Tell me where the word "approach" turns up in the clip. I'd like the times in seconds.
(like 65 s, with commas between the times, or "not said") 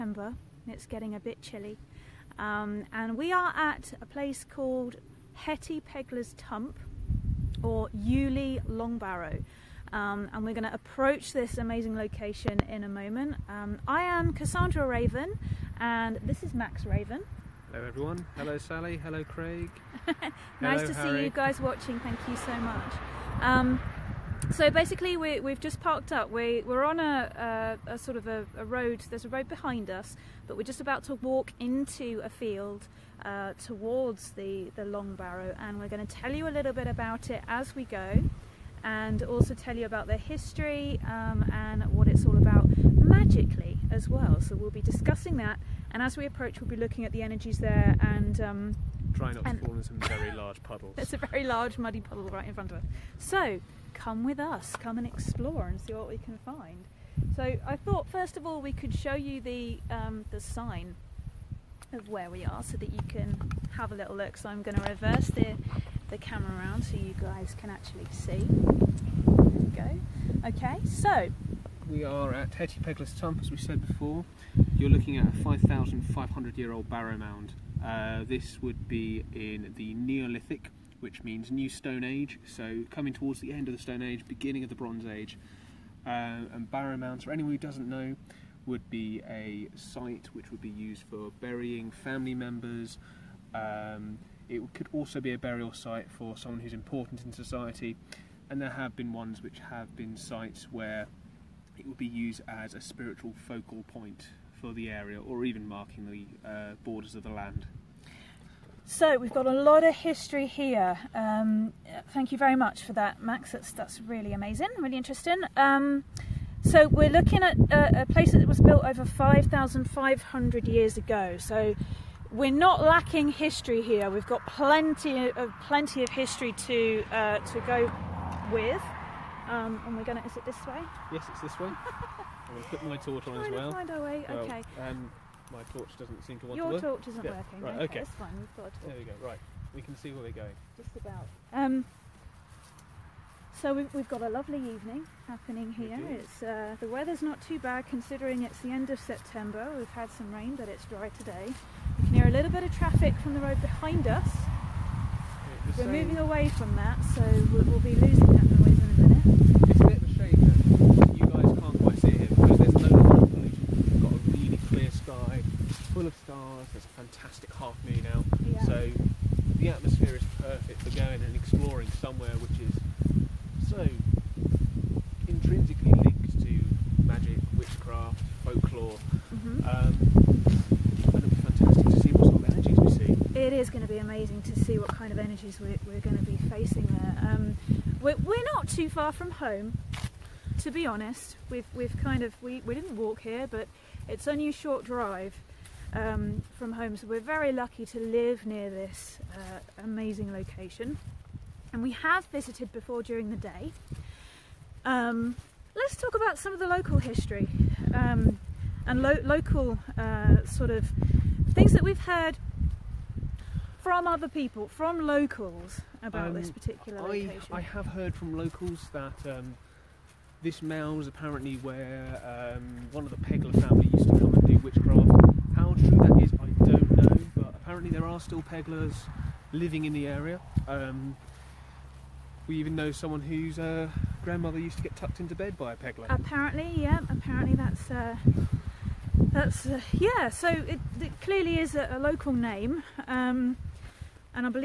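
10 s, 46 s.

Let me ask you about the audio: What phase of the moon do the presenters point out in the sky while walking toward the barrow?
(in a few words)
half moon.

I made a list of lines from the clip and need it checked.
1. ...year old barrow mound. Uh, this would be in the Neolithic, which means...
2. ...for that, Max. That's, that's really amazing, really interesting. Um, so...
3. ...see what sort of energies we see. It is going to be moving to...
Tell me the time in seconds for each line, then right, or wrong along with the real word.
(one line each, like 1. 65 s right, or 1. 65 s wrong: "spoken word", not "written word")
1. 76 s right
2. 112 s right
3. 181 s wrong: "amazing", not "moving".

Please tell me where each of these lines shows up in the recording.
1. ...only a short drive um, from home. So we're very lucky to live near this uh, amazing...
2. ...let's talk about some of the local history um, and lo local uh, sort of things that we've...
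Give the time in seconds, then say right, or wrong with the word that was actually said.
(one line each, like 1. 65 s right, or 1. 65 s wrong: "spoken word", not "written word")
1. 194 s right
2. 205 s right.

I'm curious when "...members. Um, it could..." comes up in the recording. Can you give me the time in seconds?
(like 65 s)
92 s.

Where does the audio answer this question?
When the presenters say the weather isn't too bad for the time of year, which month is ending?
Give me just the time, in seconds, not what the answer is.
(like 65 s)
148 s.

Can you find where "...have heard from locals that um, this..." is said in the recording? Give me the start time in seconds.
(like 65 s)
217 s.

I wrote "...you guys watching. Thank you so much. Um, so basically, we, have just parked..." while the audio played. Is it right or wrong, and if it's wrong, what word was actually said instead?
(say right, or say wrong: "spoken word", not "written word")
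right.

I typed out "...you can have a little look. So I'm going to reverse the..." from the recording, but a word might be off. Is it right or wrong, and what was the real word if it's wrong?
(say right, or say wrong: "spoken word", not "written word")
right.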